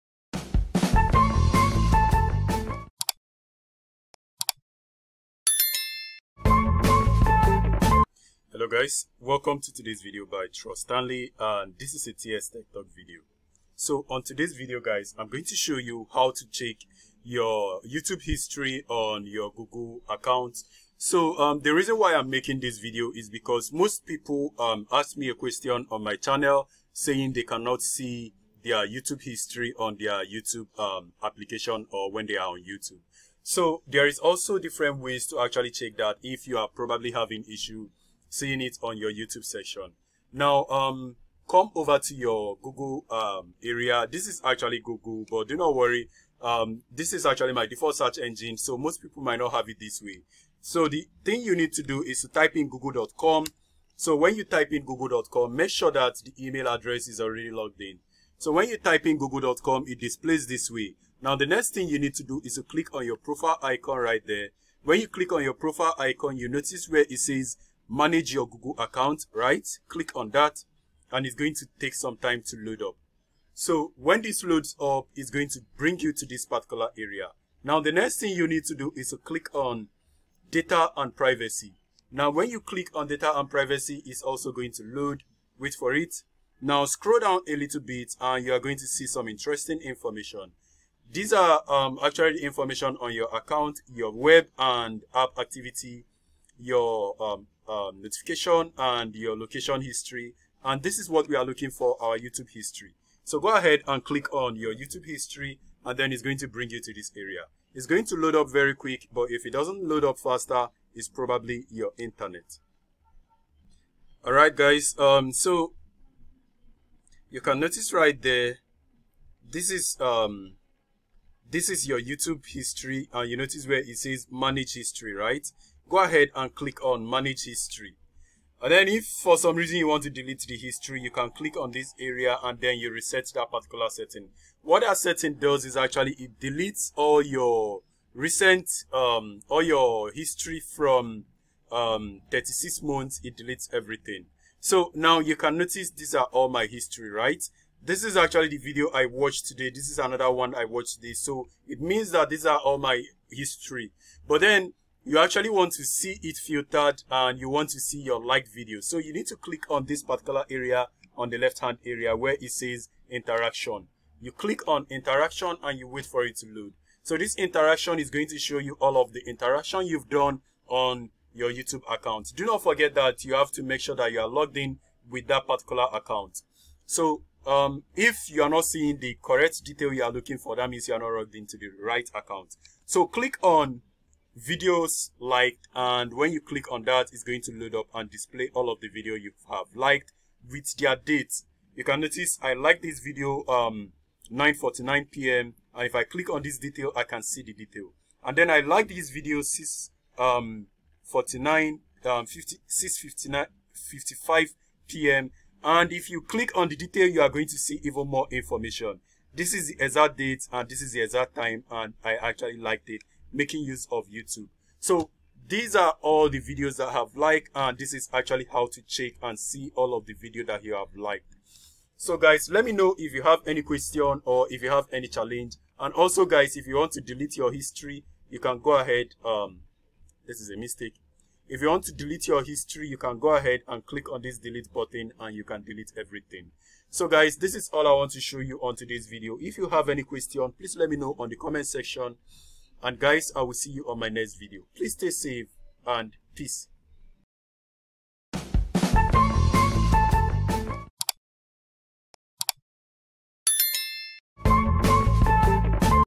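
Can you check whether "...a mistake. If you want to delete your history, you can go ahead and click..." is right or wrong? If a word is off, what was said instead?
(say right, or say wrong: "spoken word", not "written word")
right.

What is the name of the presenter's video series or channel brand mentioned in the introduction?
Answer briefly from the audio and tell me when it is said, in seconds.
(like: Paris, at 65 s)
TS Tech Talk, at 12 s.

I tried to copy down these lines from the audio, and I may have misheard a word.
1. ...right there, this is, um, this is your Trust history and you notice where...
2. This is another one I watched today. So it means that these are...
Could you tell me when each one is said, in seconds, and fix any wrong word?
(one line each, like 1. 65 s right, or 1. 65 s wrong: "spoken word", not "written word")
1. 117 s wrong: "YouTube", not "Trust"
2. 149 s right.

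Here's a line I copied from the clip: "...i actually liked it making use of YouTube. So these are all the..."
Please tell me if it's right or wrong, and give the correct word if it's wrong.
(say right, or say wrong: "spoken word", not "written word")
right.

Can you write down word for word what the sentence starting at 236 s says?
So guys, this is all I want to show you on today's video.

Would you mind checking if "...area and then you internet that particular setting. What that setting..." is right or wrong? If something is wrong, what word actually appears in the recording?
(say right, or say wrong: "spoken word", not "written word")
wrong: "reset", not "internet".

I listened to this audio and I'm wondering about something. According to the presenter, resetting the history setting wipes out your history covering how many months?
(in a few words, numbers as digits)
36.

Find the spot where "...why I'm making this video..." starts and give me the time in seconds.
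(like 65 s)
21 s.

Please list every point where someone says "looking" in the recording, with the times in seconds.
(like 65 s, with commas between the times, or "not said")
101 s, 180 s.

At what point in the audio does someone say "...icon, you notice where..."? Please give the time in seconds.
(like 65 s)
65 s.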